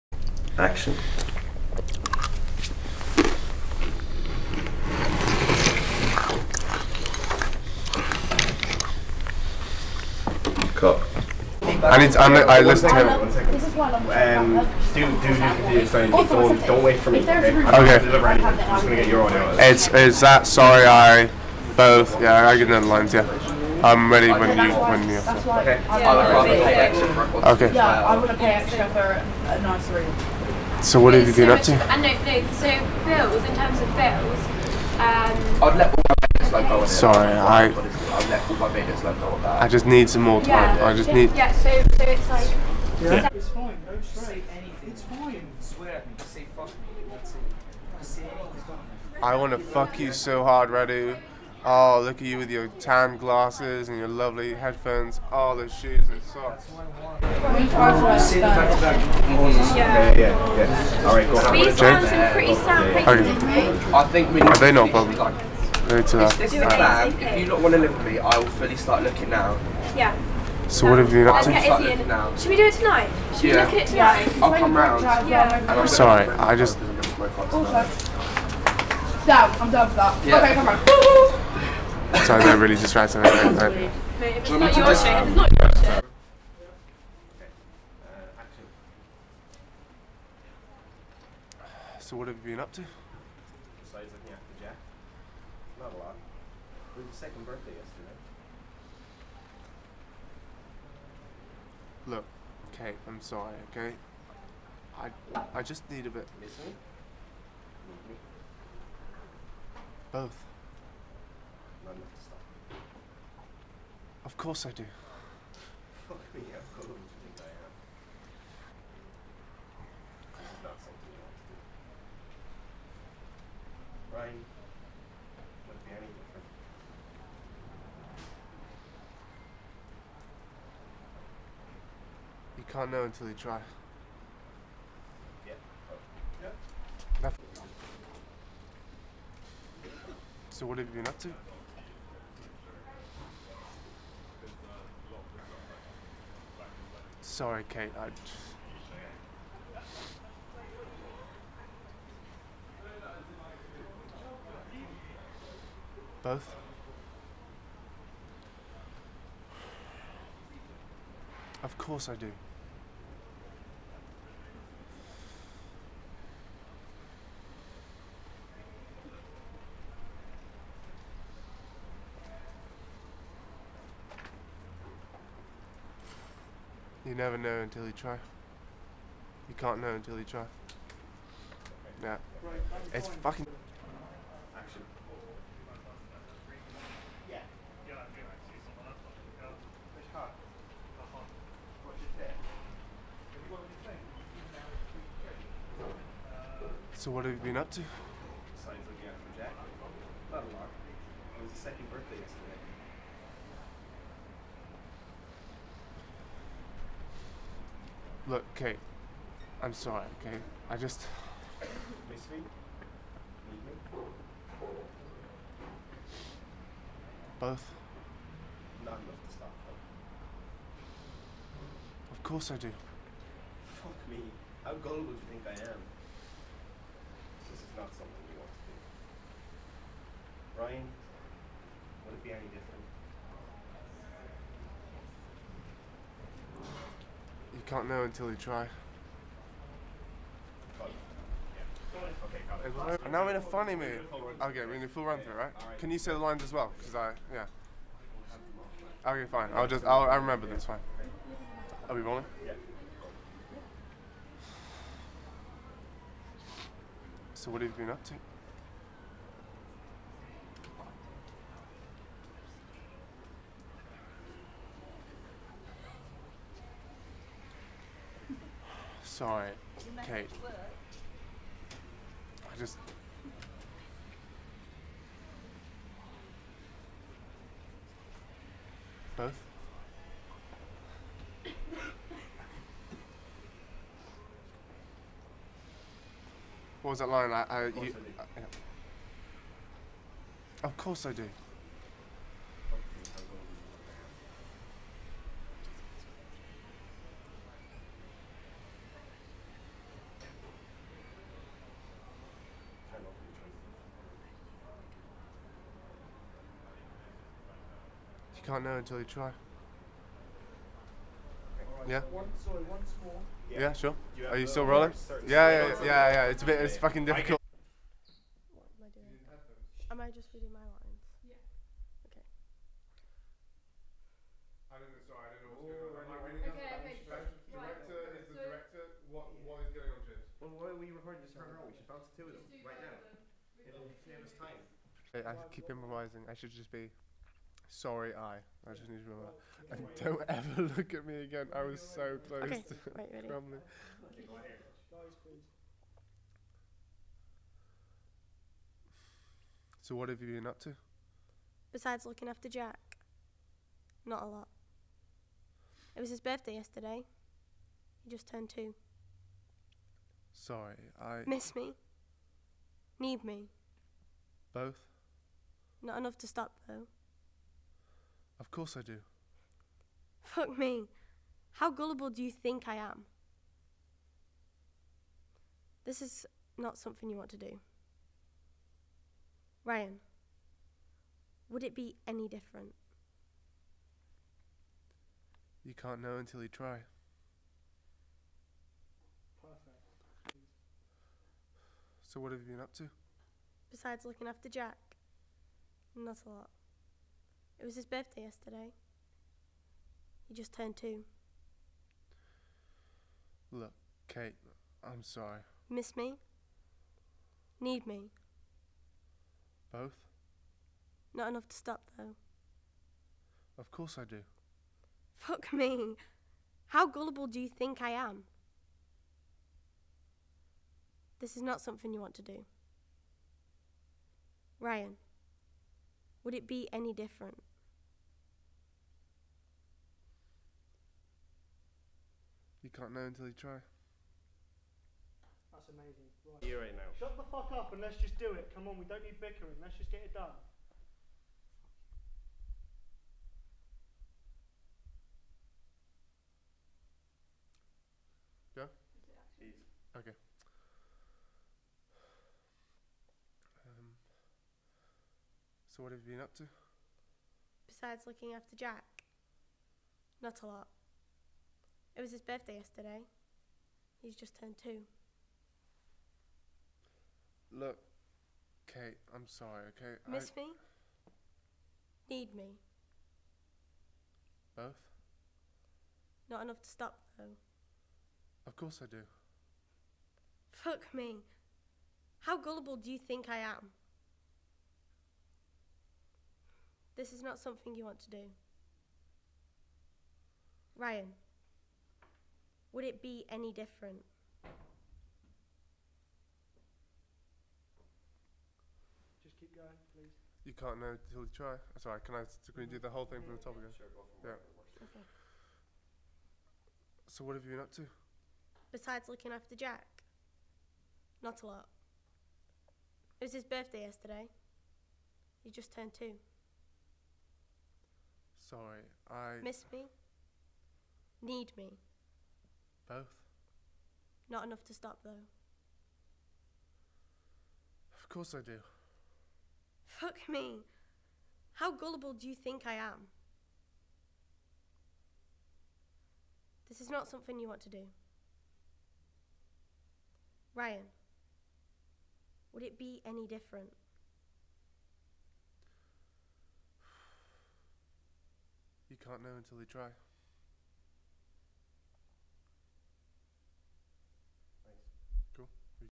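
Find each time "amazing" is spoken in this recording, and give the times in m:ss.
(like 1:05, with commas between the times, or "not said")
7:15.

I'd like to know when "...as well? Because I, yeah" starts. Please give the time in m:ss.
4:06.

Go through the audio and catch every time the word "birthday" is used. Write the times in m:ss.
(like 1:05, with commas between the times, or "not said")
1:37, 3:21, 5:56, 6:37, 7:42, 8:33.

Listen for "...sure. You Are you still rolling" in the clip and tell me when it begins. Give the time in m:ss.
5:13.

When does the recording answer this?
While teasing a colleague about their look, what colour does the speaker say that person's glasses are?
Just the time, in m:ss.
0:52.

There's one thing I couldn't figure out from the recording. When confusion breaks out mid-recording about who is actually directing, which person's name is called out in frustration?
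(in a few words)
James.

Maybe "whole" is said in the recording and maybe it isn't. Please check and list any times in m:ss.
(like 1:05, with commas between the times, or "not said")
8:22.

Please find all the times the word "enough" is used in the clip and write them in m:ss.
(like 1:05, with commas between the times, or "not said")
6:05, 6:51, 7:56, 8:44.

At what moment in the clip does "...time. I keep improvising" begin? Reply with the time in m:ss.
5:34.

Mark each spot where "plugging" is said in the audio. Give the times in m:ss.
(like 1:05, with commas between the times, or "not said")
not said.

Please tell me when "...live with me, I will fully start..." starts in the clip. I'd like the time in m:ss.
1:07.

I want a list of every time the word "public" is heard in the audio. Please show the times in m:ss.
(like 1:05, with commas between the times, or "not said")
1:04.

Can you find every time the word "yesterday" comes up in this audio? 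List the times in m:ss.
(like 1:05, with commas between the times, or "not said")
1:37, 3:22, 5:56, 6:38, 7:42, 8:33.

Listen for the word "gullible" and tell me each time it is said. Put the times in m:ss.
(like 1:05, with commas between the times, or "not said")
3:44, 6:11, 6:56, 8:02, 8:51.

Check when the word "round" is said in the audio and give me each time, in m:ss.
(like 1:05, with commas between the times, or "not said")
1:14, 1:20.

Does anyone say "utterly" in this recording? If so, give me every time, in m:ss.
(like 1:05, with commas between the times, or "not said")
not said.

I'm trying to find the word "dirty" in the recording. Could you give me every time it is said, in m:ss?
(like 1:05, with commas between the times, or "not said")
not said.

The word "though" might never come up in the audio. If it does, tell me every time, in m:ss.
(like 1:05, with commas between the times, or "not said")
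6:06, 6:51, 7:57, 8:45.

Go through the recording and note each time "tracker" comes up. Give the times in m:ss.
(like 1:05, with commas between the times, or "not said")
not said.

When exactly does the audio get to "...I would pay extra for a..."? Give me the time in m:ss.
0:28.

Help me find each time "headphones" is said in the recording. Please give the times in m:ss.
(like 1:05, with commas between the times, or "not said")
0:54.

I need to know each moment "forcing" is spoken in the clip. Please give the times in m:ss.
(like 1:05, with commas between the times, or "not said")
not said.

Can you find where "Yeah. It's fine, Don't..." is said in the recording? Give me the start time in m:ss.
0:43.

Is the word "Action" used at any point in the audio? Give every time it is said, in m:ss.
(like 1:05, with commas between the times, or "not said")
0:00, 3:04.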